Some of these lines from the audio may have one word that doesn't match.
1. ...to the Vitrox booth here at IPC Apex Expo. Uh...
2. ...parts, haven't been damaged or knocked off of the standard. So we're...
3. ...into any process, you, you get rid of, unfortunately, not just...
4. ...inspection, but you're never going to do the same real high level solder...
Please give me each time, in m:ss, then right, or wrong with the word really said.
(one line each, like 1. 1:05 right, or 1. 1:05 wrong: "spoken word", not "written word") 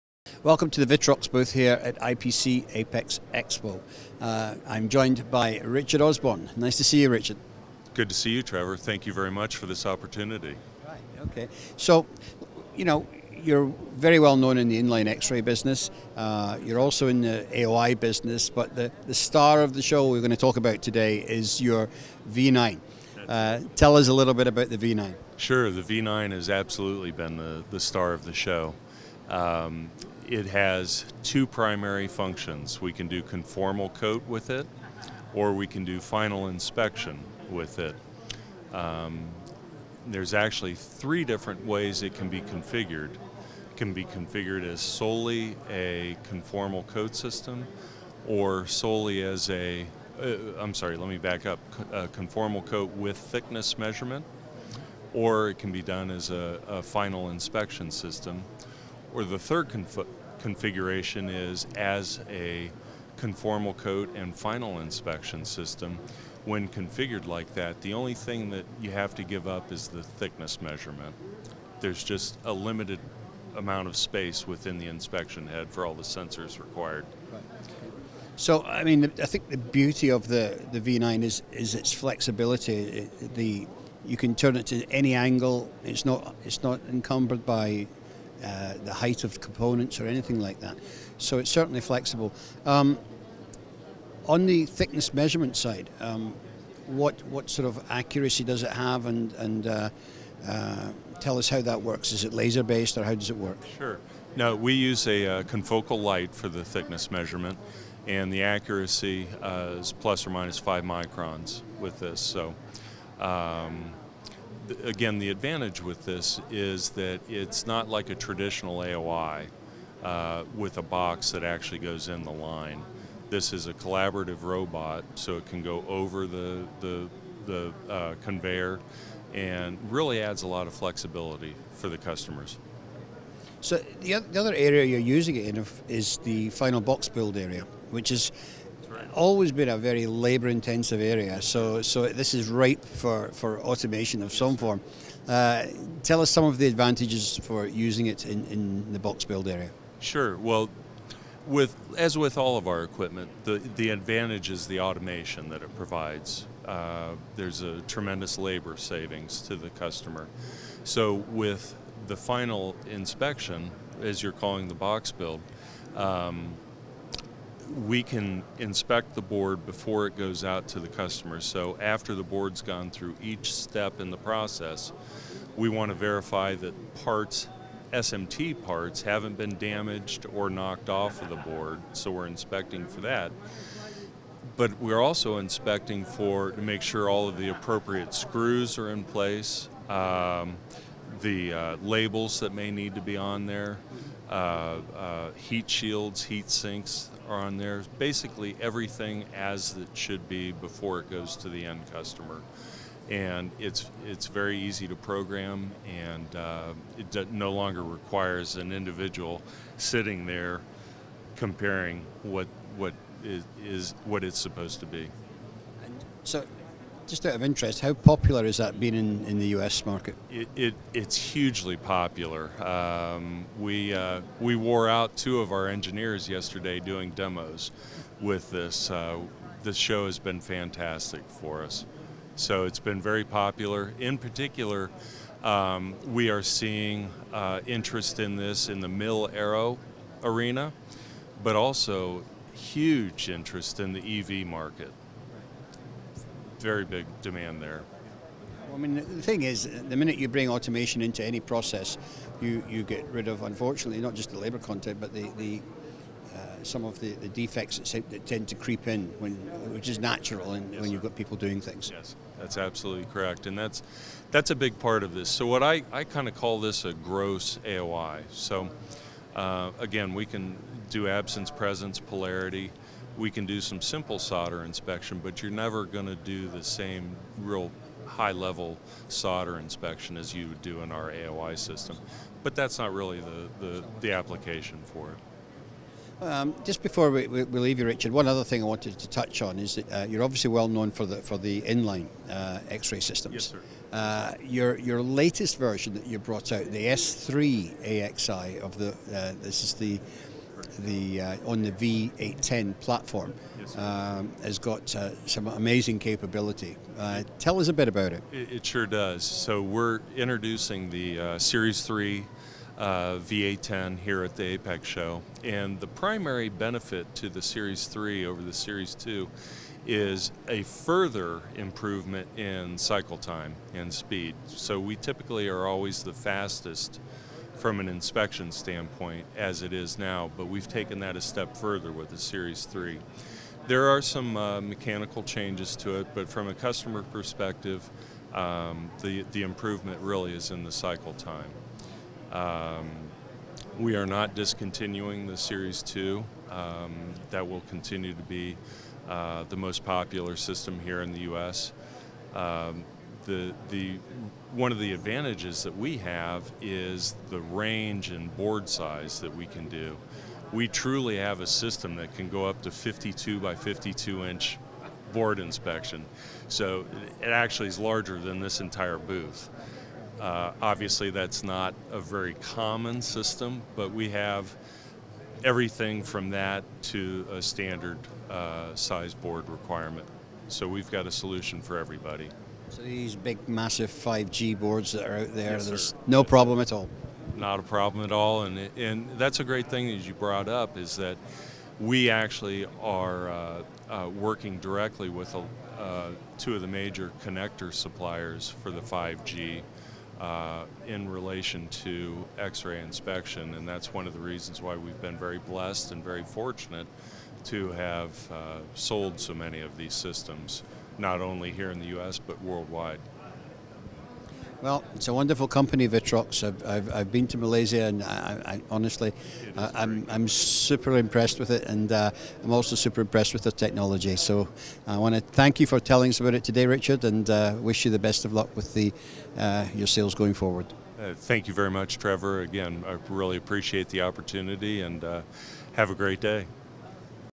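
1. 0:00 right
2. 2:58 wrong: "board", not "standard"
3. 4:11 right
4. 4:34 right.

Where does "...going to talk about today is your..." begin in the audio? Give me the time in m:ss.
0:20.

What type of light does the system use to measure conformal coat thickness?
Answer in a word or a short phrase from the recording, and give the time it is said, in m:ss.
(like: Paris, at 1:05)
Confocal light, at 1:45.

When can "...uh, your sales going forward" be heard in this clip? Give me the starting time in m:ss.
7:09.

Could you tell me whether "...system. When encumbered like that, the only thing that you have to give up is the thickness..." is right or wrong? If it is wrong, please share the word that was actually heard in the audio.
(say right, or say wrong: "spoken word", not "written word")
wrong: "configured", not "encumbered".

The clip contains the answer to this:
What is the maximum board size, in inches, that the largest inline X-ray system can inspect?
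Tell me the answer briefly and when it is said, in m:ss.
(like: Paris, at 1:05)
52 by 52 inches, at 6:02.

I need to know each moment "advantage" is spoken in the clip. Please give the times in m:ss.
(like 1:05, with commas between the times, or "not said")
1:55, 2:26, 2:33, 5:54.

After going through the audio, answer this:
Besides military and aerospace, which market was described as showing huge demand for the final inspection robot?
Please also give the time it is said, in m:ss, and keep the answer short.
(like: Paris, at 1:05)
EV market, at 4:04.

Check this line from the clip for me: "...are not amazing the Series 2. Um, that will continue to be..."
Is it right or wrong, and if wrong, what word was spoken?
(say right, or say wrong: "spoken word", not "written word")
wrong: "discontinuing", not "amazing".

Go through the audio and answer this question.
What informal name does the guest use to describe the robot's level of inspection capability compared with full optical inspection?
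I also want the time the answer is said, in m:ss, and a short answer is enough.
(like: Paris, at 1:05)
Gross AOI, at 4:26.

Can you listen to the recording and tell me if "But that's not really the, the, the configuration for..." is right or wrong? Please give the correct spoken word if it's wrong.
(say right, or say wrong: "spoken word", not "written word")
wrong: "application", not "configuration".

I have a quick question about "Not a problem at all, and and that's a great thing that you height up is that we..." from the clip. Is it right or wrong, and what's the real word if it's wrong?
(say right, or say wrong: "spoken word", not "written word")
wrong: "brought", not "height".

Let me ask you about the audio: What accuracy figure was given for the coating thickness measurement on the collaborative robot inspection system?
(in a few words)
plus or minus 5 microns.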